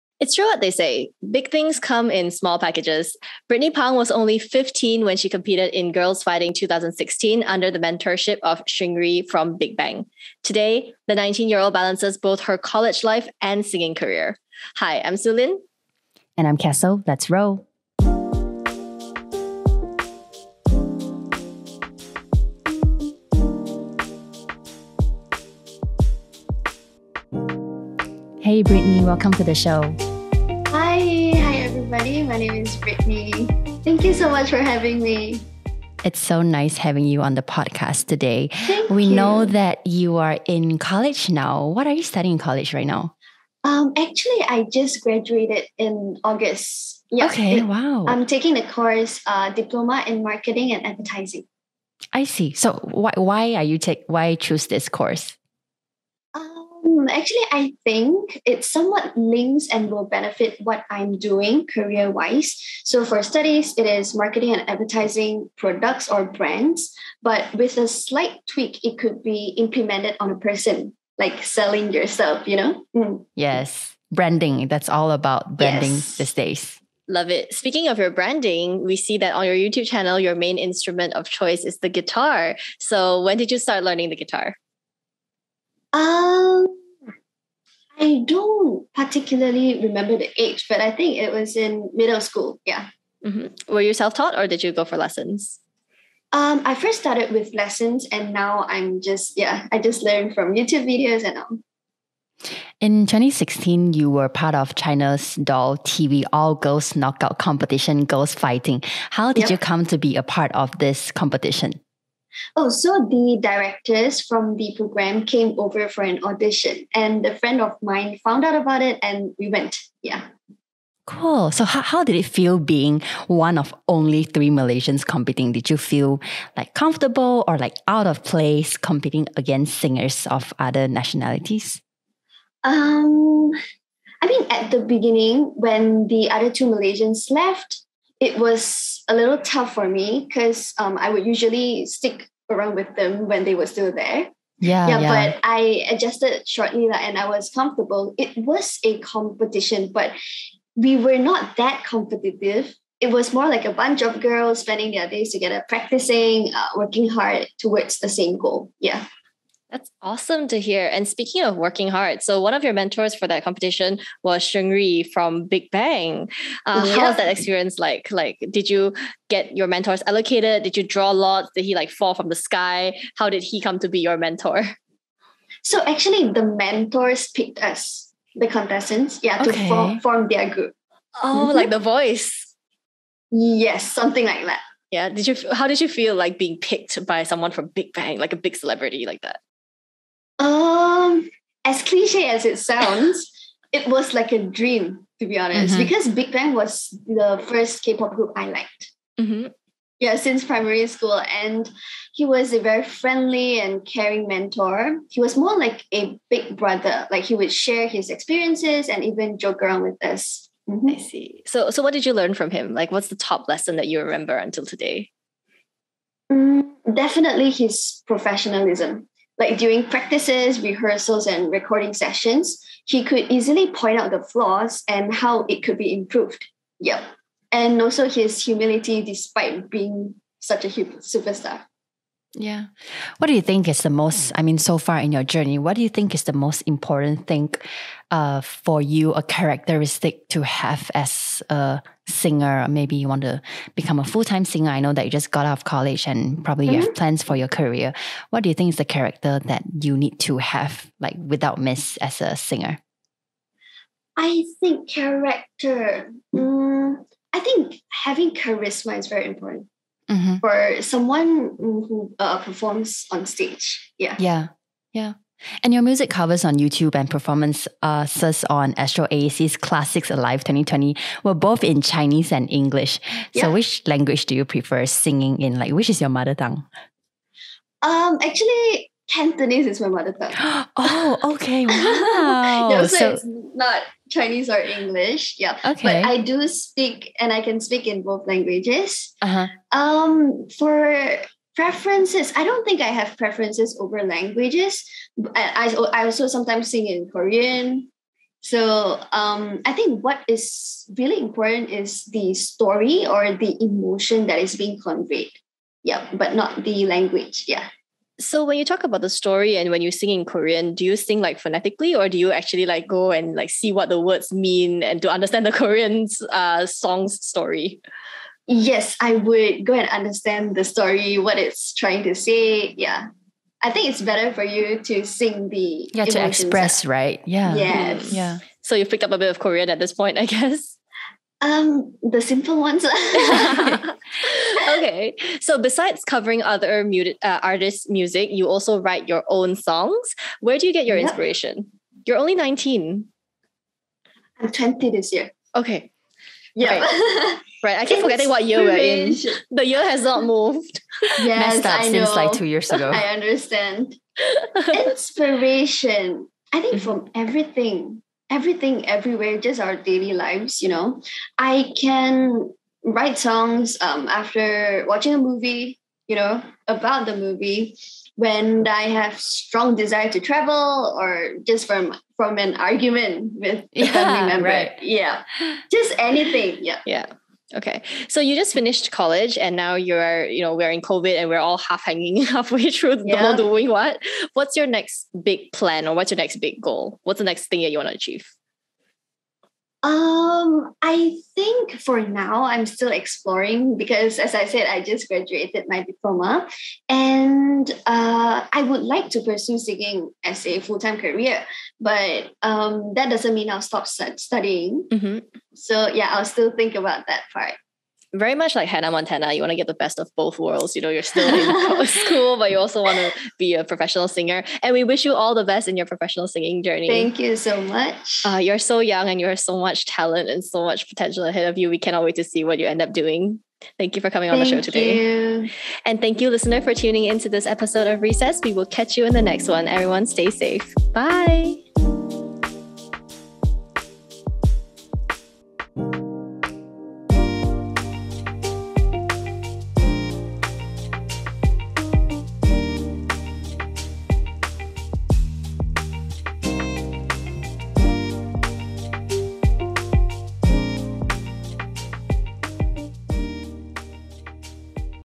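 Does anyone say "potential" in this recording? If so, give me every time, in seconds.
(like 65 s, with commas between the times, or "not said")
420 s.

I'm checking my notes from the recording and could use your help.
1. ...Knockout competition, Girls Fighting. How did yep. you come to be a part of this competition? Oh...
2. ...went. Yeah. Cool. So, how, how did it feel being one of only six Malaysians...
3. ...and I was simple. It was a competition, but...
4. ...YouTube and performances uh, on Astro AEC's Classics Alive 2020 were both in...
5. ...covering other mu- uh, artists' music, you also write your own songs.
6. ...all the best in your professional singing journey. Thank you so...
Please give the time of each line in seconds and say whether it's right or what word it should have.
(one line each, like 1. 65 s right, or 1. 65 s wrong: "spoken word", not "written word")
1. 106 s right
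2. 119 s wrong: "three", not "six"
3. 146 s wrong: "comfortable", not "simple"
4. 266 s right
5. 336 s right
6. 415 s right.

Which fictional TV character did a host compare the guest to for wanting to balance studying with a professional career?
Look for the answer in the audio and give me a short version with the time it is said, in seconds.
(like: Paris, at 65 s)
Hannah Montana, at 408 s.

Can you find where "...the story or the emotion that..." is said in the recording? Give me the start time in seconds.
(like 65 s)
302 s.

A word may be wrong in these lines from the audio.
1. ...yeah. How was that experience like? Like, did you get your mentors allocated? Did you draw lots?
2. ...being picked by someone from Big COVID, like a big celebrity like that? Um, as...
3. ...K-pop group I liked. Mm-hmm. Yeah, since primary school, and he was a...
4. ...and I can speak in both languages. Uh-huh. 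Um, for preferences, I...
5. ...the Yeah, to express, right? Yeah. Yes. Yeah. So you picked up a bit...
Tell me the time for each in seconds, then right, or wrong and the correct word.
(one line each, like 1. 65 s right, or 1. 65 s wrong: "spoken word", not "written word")
1. 166 s right
2. 186 s wrong: "Bang", not "COVID"
3. 197 s right
4. 287 s right
5. 325 s right.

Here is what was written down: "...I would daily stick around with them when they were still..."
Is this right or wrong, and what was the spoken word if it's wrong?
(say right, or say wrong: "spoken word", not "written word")
wrong: "usually", not "daily".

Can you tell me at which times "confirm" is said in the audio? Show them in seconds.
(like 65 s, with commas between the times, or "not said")
not said.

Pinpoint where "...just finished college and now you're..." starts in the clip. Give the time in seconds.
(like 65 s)
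378 s.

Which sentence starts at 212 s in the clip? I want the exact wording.
Like, what's the top lesson that you remember until today?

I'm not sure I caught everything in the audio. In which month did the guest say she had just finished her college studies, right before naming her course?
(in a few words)
August.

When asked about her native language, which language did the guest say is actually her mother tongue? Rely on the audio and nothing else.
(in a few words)
Cantonese.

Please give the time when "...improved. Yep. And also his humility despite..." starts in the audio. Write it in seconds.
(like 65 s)
225 s.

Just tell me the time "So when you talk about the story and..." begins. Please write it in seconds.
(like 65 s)
308 s.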